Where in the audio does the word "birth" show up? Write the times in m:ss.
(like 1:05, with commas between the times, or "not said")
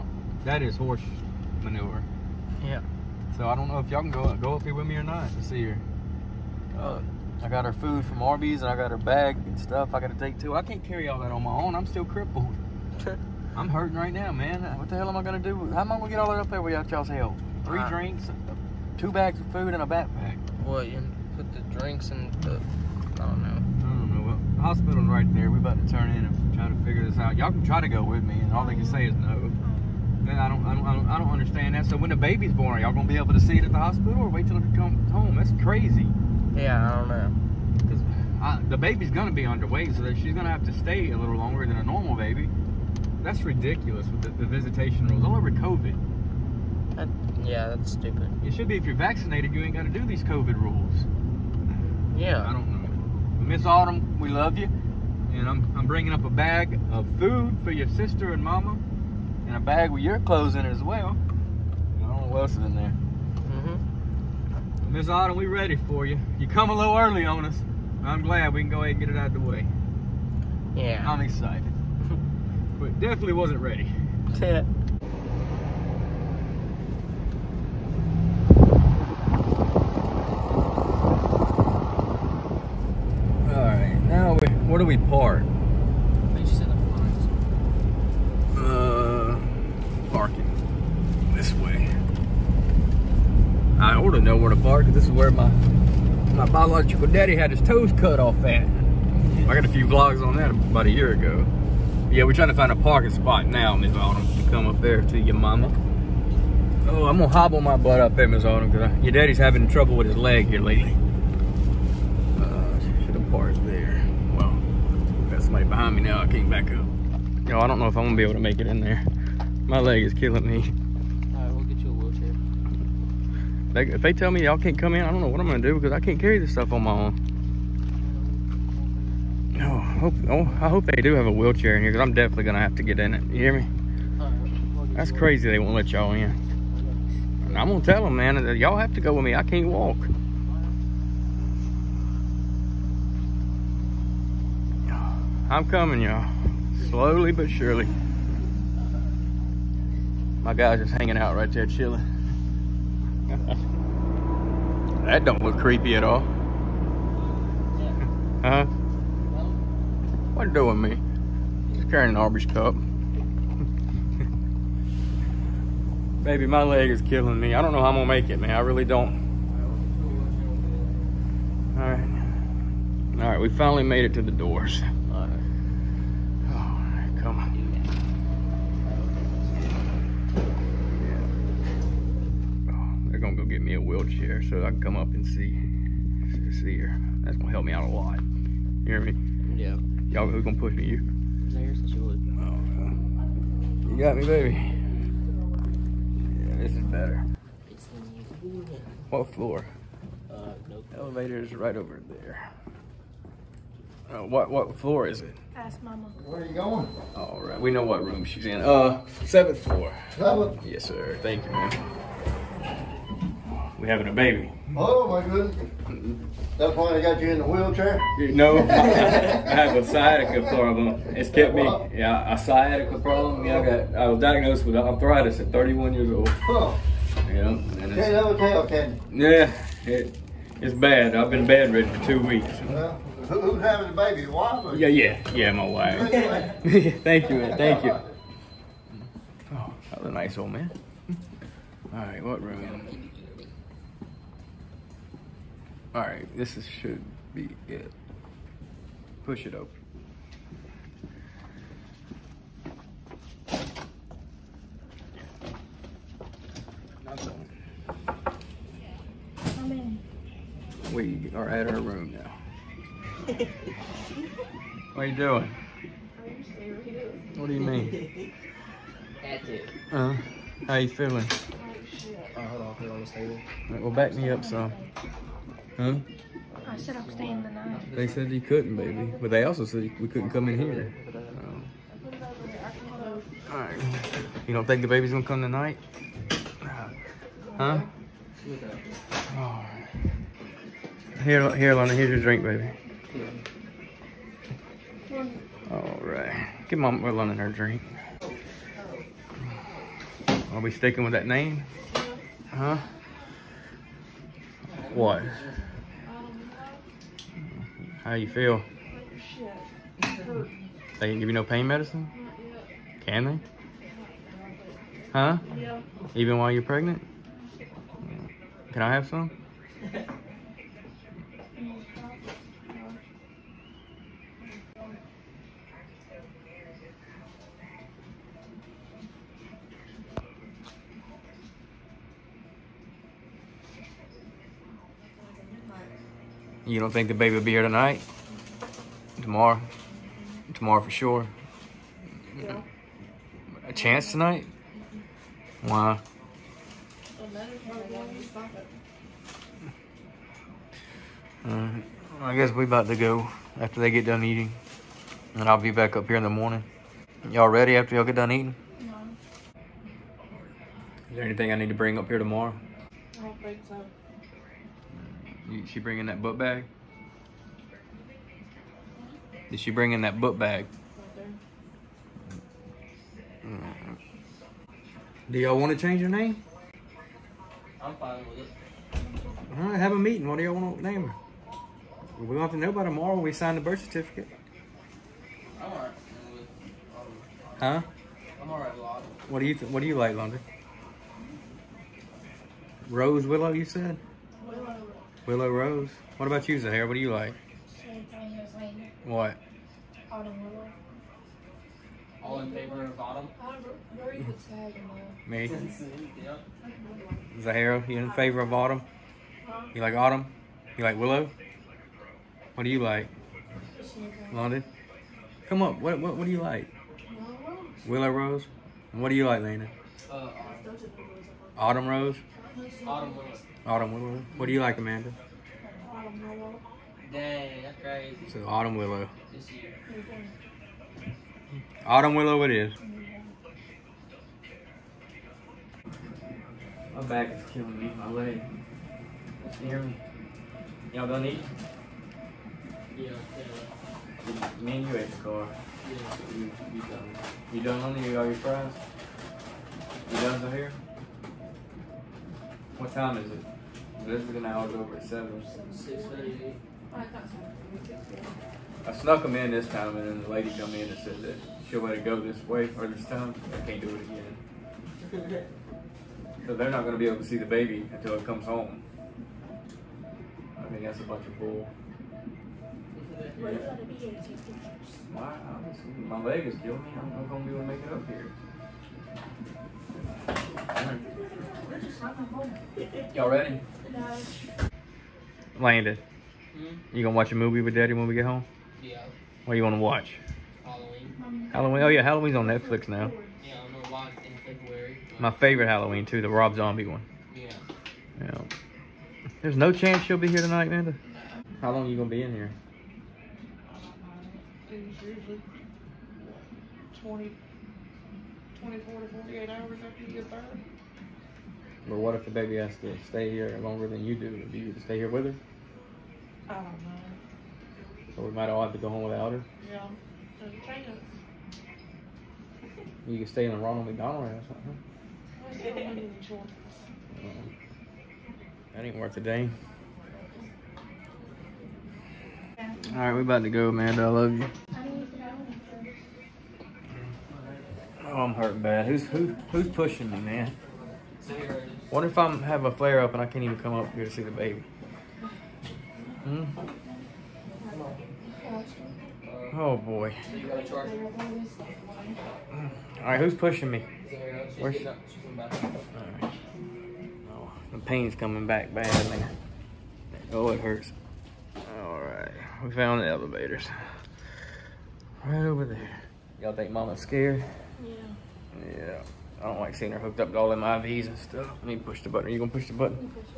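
6:23, 8:30.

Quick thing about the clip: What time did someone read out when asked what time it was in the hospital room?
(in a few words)
6:38.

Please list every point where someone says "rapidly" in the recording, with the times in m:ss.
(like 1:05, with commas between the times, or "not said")
not said.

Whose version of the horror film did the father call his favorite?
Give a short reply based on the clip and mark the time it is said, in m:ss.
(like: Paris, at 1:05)
Rob Zombie, at 8:16.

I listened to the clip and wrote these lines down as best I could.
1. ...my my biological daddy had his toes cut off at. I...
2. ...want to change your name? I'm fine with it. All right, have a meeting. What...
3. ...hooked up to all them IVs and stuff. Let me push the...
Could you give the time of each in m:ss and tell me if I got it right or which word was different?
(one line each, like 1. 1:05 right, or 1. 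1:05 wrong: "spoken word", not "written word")
1. 1:35 right
2. 6:15 right
3. 9:29 right.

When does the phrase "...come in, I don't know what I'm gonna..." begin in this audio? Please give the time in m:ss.
2:04.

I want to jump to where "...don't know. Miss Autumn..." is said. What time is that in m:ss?
0:52.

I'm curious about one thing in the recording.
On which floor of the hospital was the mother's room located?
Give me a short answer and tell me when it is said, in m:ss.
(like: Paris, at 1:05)
Seventh floor, at 3:29.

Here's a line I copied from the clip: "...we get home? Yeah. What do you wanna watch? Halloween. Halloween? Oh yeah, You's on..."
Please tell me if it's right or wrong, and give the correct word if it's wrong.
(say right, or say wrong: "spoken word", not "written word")
wrong: "Halloween", not "You".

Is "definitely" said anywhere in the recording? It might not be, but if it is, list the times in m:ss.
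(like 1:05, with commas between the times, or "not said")
1:13, 2:12.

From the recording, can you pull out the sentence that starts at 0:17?
Three drinks, two bags of food, and a backpack.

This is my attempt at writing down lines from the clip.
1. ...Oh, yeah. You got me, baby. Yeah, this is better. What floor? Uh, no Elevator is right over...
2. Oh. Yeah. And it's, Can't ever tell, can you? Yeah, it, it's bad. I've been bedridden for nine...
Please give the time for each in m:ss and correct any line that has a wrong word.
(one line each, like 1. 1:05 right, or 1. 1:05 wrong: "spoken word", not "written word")
1. 3:12 right
2. 3:46 wrong: "two", not "nine".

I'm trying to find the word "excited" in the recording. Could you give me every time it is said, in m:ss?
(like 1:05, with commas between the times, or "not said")
1:11.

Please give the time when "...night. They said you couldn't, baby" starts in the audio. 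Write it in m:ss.
4:37.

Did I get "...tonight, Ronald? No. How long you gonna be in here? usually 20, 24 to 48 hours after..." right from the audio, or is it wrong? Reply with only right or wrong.
wrong.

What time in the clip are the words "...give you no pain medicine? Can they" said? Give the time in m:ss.
5:11.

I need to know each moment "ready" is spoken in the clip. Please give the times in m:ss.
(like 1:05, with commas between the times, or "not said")
1:05, 1:13, 5:57, 8:03.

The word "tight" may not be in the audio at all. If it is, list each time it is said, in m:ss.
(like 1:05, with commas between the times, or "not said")
not said.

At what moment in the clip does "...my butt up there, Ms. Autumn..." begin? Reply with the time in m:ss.
1:47.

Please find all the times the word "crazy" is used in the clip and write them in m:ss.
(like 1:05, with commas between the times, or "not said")
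0:35, 2:15, 7:07.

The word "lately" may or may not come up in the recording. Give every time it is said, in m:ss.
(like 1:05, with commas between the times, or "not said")
1:50.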